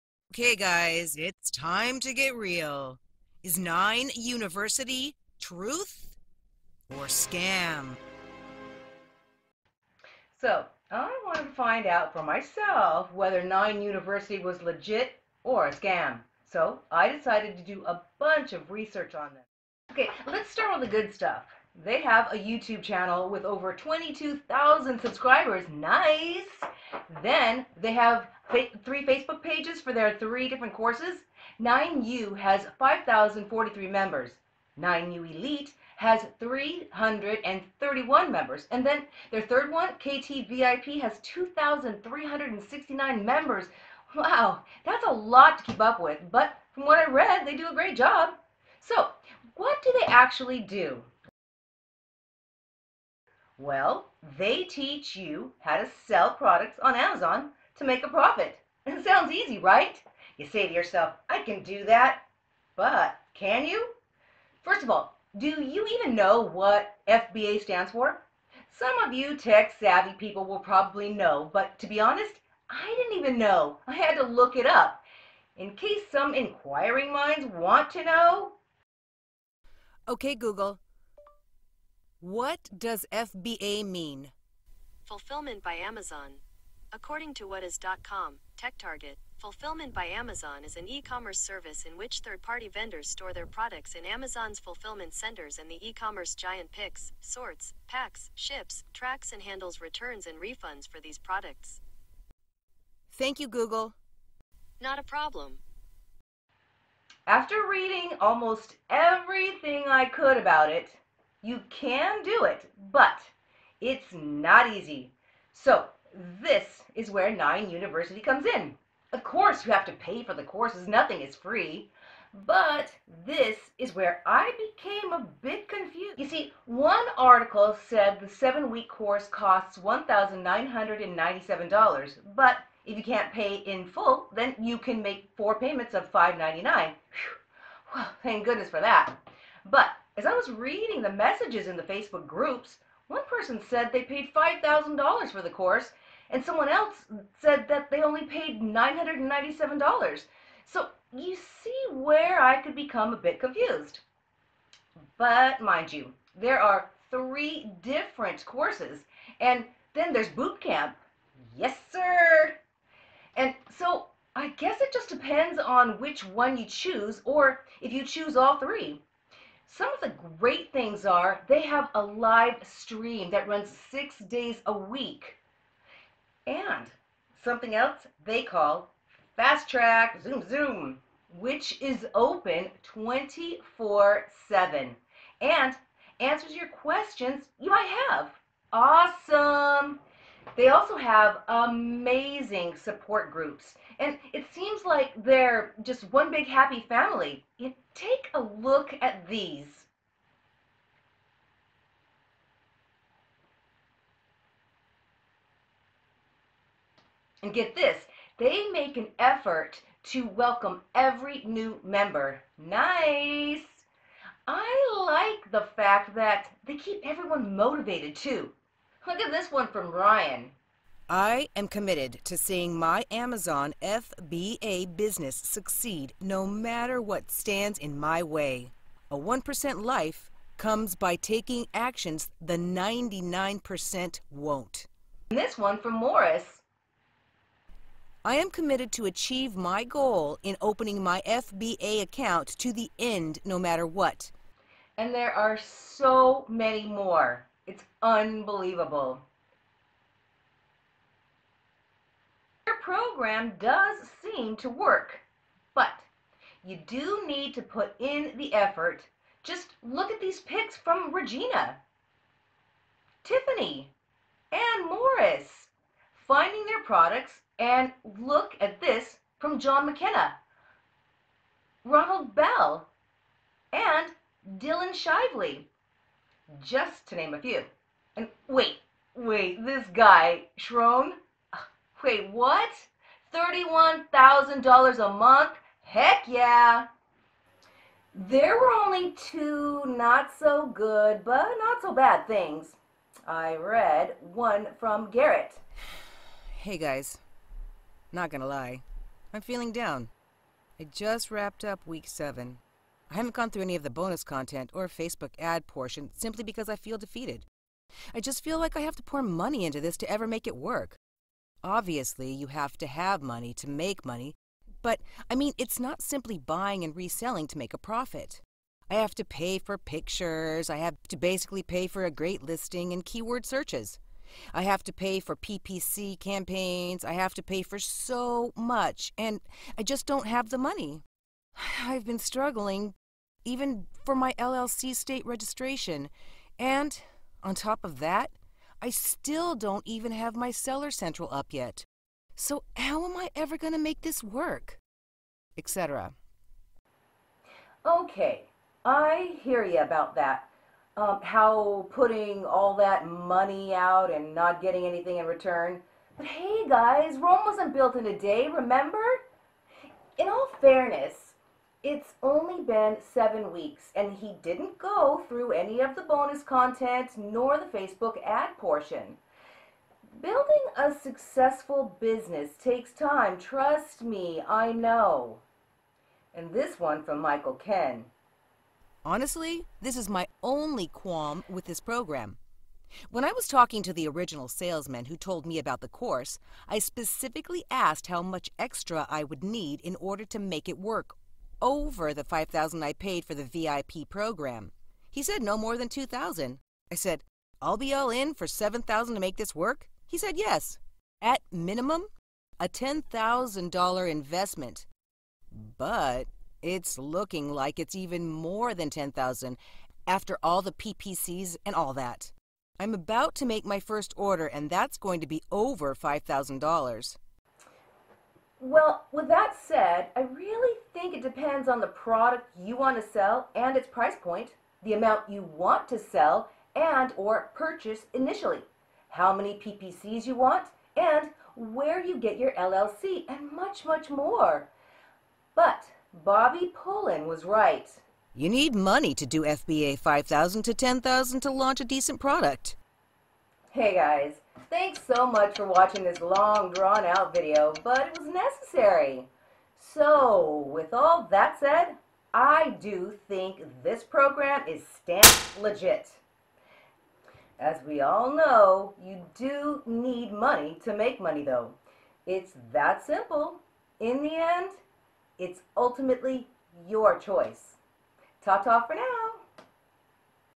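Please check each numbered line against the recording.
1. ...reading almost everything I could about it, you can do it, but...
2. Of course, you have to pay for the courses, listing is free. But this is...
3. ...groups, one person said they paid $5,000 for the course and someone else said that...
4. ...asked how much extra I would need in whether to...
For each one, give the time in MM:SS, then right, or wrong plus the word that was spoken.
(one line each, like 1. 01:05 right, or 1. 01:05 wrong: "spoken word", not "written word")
1. 01:47 right
2. 01:59 wrong: "nothing", not "listing"
3. 02:22 right
4. 06:27 wrong: "order", not "whether".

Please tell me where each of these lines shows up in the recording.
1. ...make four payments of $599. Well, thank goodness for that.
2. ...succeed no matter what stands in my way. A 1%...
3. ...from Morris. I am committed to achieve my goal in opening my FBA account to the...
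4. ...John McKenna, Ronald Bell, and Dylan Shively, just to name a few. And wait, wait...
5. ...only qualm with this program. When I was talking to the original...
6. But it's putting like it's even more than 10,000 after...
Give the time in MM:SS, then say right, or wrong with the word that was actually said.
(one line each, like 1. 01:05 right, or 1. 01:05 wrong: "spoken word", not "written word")
1. 02:15 right
2. 03:45 right
3. 03:55 right
4. 04:29 right
5. 06:20 right
6. 06:45 wrong: "looking", not "putting".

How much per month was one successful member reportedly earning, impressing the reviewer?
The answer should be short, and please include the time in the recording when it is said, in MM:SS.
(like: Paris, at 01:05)
$31,000, at 04:43.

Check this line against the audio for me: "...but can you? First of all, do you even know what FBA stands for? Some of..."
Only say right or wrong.
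right.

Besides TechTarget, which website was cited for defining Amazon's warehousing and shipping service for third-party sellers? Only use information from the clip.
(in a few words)
whatis.com.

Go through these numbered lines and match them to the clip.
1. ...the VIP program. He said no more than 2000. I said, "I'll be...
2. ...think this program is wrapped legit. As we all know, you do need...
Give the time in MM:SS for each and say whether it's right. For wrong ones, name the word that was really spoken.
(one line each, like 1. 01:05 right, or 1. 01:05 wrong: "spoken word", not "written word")
1. 06:33 right
2. 07:33 wrong: "stamped", not "wrapped".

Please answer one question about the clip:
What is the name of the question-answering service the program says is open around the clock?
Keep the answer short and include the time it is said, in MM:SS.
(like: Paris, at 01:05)
Fast Track Zoom Zoom, at 02:59.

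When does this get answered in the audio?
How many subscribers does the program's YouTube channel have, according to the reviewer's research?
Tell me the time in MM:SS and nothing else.
00:23.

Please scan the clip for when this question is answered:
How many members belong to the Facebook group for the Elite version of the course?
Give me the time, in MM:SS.
00:36.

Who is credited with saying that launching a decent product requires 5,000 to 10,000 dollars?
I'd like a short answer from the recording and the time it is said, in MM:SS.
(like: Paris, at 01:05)
Bobby Pullen, at 07:16.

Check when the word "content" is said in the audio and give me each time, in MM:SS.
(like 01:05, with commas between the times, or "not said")
05:04, 06:06.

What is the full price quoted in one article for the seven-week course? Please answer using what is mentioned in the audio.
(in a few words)
$1,997.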